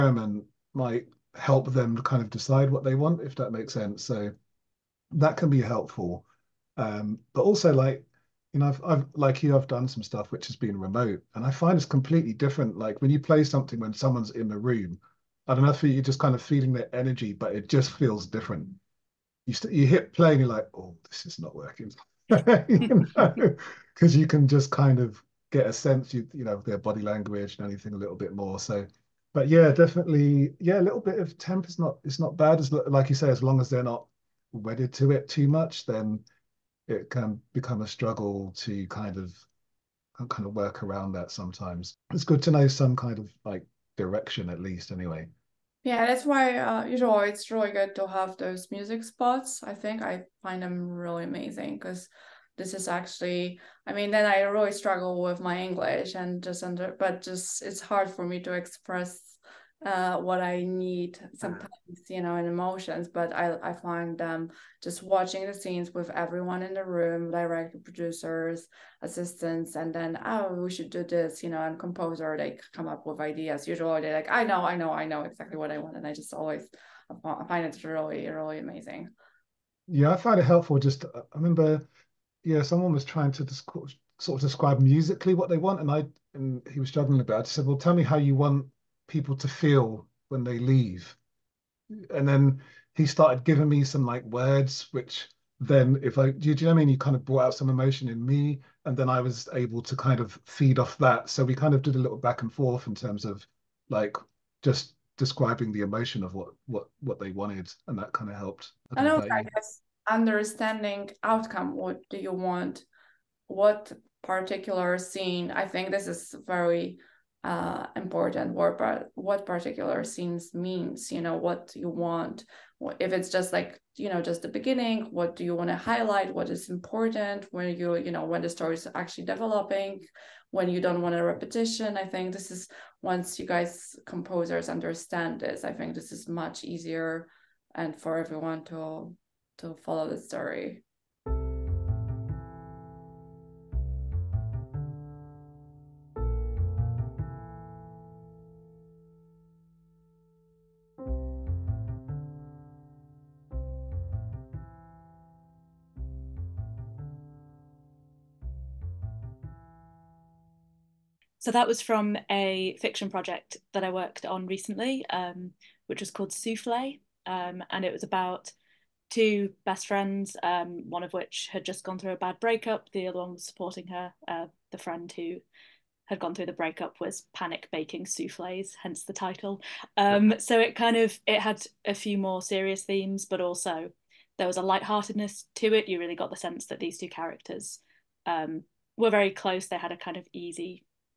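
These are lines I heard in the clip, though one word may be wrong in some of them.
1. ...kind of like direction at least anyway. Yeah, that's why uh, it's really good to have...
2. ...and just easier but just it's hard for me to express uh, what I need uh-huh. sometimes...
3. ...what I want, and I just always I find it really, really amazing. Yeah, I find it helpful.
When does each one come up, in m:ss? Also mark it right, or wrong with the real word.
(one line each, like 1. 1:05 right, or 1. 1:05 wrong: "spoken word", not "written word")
1. 0:42 right
2. 0:56 wrong: "under", not "easier"
3. 1:15 right.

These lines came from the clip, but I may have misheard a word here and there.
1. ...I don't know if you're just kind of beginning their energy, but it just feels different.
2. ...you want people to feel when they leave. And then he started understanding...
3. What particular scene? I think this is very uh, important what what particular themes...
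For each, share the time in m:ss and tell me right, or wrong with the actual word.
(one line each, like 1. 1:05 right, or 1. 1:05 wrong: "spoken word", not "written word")
1. 0:15 wrong: "feeling", not "beginning"
2. 1:28 wrong: "giving", not "understanding"
3. 1:53 wrong: "scenes", not "themes".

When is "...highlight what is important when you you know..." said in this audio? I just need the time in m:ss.
2:05.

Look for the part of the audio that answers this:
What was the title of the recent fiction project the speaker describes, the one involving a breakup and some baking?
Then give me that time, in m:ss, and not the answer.
2:46.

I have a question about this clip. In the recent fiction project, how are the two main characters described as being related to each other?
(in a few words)
best friends.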